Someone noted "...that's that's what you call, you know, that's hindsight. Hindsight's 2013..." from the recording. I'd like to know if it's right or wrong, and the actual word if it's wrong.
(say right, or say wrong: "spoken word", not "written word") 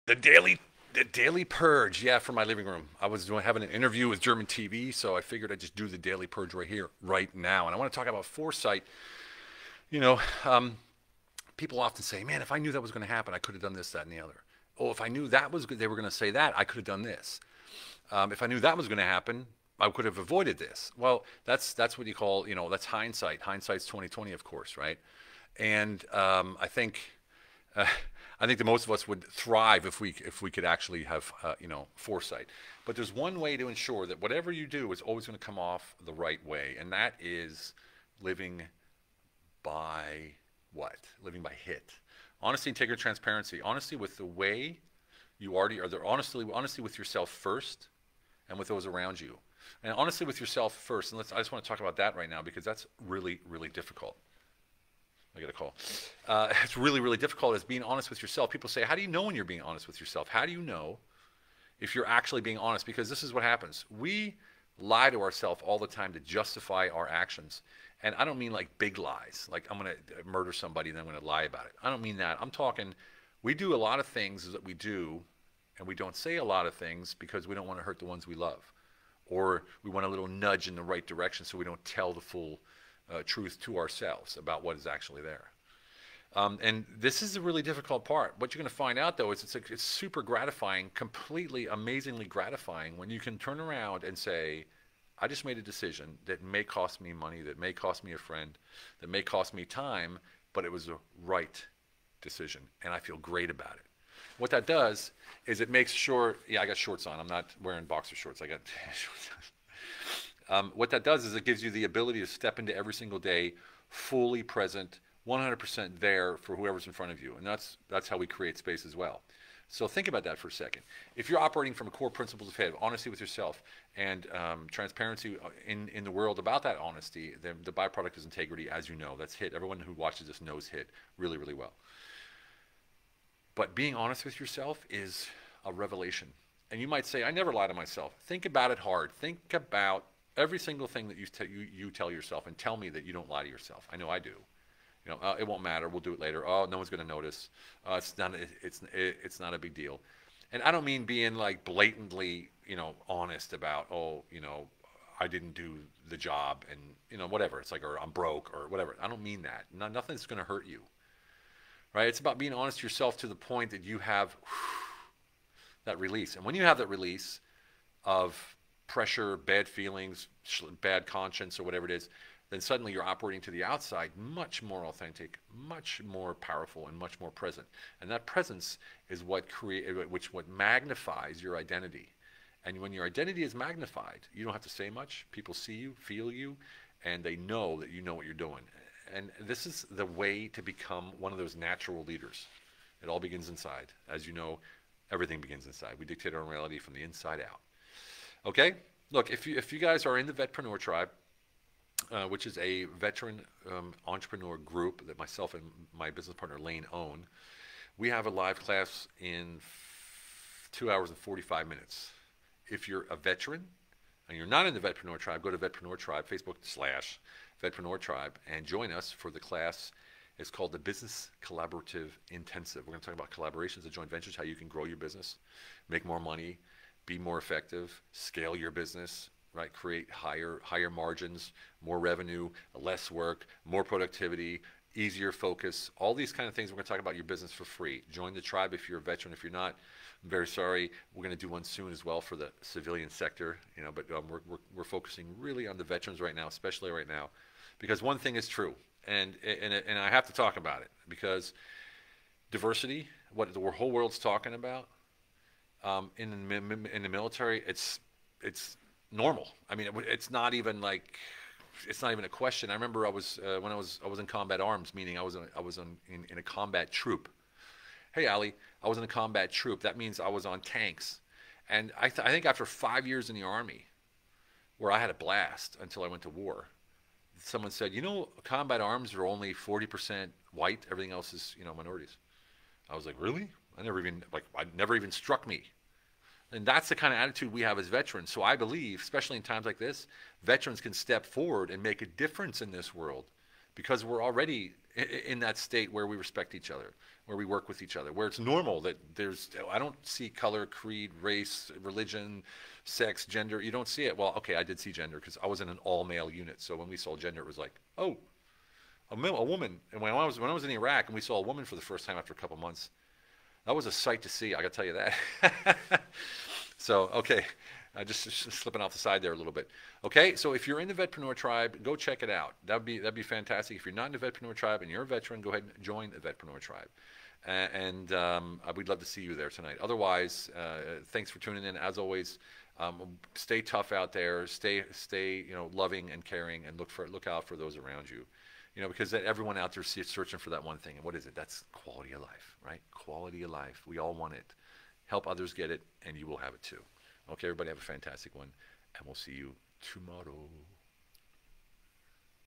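wrong: "2020", not "2013".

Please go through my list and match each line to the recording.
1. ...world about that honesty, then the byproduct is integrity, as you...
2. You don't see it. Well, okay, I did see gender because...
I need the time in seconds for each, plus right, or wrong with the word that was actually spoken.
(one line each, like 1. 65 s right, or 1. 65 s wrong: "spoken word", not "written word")
1. 126 s right
2. 303 s right.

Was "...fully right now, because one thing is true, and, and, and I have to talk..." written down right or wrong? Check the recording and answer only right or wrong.
wrong.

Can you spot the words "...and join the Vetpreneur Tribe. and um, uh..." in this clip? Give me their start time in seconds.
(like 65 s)
325 s.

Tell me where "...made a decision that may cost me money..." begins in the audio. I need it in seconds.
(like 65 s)
95 s.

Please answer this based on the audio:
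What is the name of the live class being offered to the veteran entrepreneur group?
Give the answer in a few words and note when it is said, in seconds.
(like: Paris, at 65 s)
Business Collaborative Intensive, at 220 s.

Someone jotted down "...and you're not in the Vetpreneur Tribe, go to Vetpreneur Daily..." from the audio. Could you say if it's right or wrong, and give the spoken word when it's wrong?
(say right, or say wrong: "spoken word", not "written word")
wrong: "Tribe", not "Daily".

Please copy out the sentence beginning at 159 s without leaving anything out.
No, nothing's going to hurt you.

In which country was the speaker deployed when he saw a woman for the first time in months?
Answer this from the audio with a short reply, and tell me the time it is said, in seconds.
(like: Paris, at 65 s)
Iraq, at 310 s.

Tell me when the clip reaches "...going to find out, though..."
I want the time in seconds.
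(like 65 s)
88 s.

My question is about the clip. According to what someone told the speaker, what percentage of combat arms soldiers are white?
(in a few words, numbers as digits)
40%.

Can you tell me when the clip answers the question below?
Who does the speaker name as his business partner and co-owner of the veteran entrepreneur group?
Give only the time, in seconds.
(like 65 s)
206 s.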